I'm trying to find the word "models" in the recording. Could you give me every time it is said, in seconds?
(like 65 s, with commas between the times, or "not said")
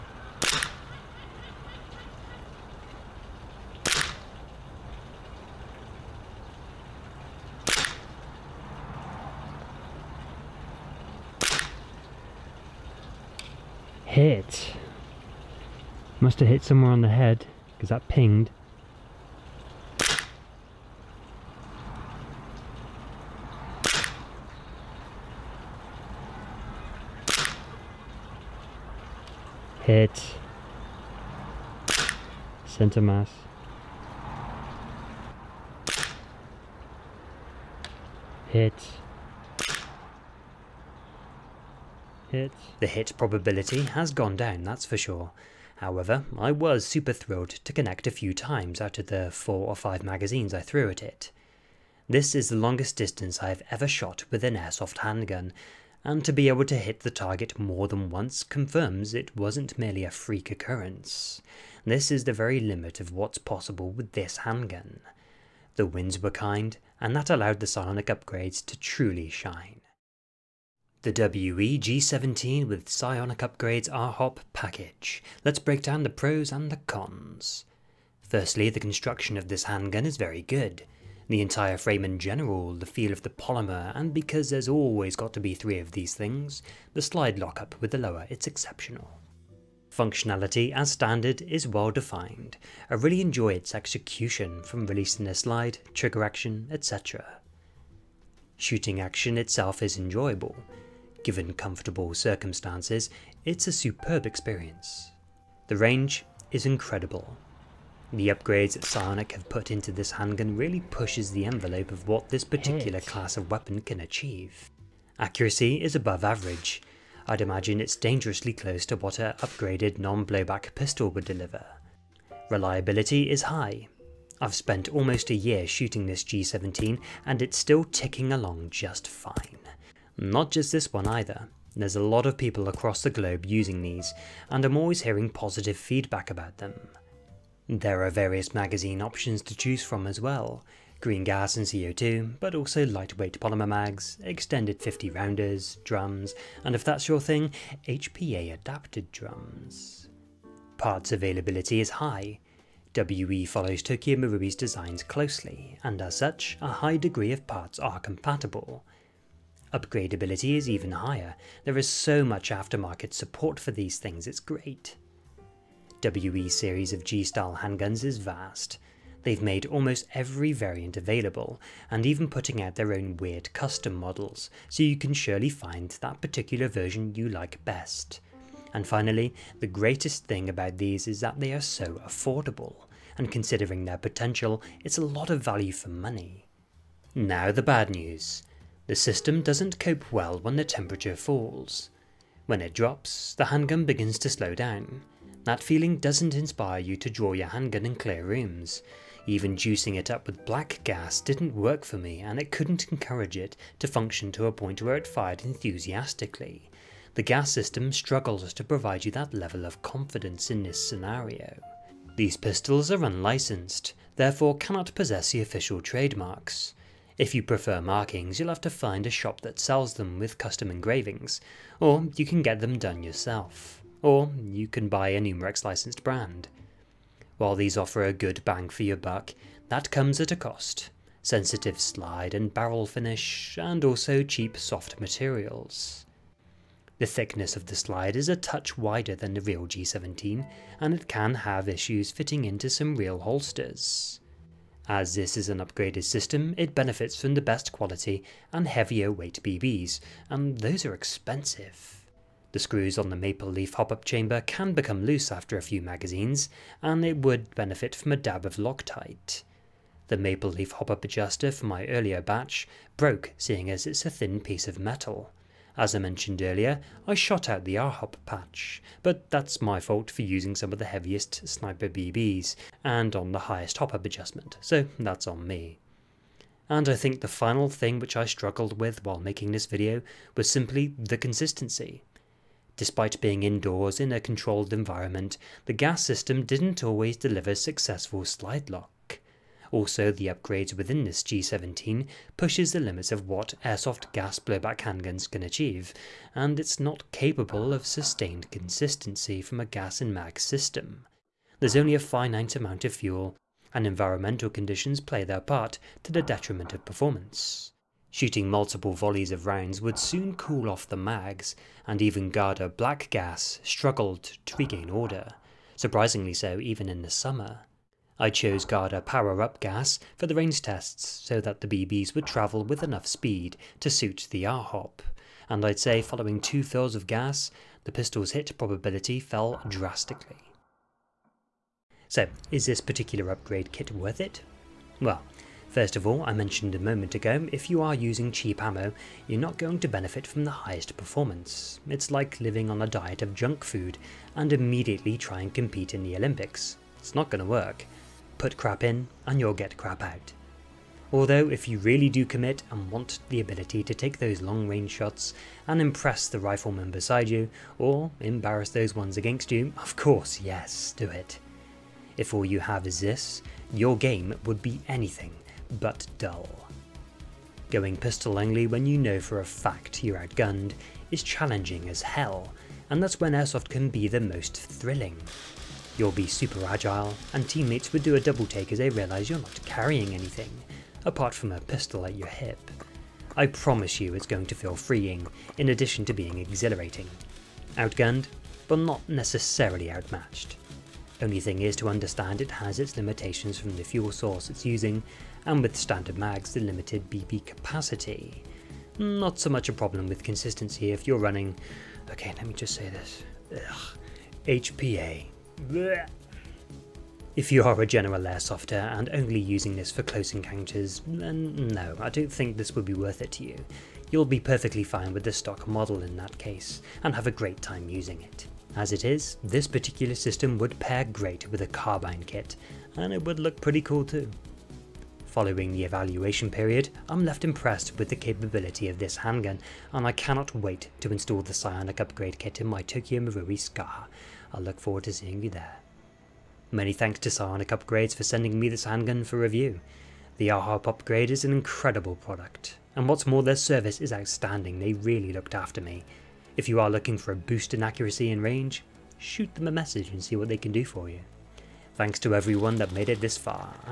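173 s, 415 s.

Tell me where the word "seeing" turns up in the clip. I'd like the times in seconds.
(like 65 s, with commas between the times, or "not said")
263 s, 435 s.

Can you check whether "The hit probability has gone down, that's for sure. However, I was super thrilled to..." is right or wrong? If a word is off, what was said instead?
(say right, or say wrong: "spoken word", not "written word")
right.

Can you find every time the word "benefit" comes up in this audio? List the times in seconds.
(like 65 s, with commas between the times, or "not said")
246 s, 257 s, 339 s.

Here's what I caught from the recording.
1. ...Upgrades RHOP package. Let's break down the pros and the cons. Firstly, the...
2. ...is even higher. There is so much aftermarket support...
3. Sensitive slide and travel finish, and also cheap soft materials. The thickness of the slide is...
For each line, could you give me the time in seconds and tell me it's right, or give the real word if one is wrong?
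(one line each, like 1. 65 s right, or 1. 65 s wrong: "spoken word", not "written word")
1. 73 s right
2. 160 s right
3. 231 s wrong: "barrel", not "travel".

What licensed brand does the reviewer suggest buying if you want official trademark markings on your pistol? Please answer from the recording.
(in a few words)
Umarex.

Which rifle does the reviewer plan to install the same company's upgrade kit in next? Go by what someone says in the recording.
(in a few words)
Tokyo Marui Scar.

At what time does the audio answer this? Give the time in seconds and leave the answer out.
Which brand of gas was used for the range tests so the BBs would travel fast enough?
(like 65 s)
318 s.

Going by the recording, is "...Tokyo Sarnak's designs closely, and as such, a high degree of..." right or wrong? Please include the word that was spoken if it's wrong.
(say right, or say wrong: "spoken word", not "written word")
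wrong: "Marui", not "Sarnak".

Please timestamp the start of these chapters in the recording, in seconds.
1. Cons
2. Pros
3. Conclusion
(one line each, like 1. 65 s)
1. 186 s
2. 69 s
3. 330 s.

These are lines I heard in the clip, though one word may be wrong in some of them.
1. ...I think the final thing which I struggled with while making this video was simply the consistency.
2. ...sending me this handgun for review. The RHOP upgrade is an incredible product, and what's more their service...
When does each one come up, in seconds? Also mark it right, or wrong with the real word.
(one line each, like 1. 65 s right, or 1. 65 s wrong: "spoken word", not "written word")
1. 276 s right
2. 438 s right.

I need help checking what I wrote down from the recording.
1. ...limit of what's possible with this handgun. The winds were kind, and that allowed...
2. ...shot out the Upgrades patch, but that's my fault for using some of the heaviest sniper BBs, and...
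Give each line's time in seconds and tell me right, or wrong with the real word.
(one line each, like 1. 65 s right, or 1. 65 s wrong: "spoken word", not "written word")
1. 62 s right
2. 267 s wrong: "RHOP", not "Upgrades".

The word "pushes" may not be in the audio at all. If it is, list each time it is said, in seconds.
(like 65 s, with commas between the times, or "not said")
110 s, 292 s.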